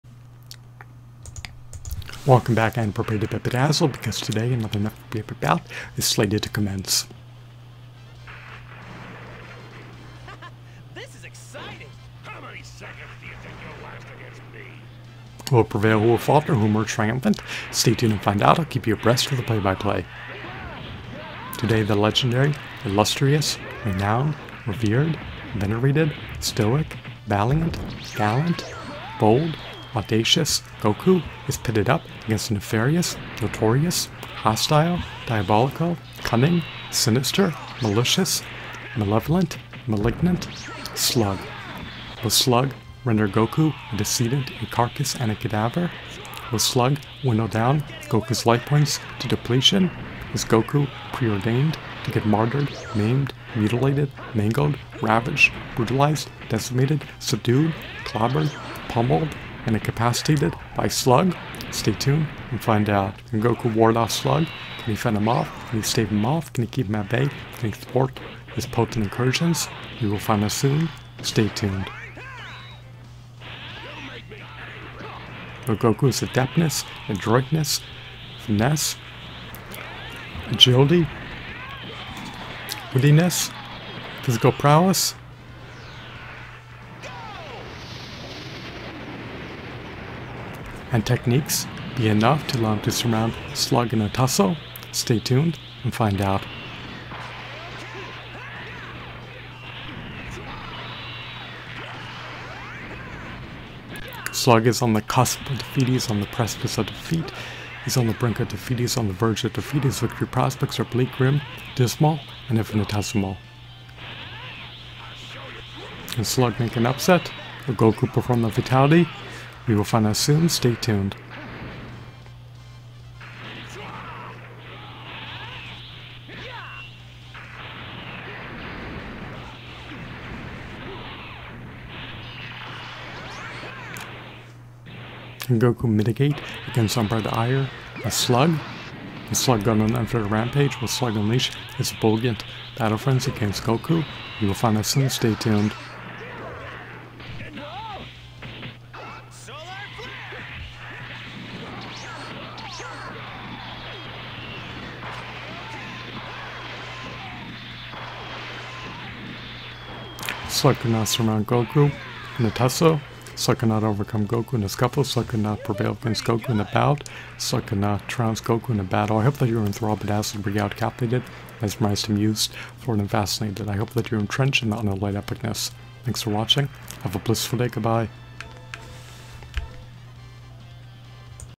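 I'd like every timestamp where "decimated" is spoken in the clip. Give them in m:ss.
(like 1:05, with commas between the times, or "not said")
0:56.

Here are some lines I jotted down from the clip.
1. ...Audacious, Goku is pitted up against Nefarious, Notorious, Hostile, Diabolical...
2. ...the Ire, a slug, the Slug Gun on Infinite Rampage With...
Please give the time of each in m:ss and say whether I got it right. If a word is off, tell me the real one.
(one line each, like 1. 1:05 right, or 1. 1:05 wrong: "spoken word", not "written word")
1. 0:29 right
2. 2:16 right.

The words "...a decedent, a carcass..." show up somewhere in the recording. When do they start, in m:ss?
0:43.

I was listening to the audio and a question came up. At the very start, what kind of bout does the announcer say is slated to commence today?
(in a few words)
Nephilim bout.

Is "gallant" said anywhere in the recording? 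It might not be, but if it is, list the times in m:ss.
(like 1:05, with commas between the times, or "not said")
0:28.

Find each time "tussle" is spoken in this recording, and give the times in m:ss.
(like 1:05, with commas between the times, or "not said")
1:34, 2:42.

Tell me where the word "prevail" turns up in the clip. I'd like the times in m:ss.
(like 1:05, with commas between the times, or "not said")
0:15, 2:45.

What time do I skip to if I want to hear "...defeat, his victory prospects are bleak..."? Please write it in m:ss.
1:49.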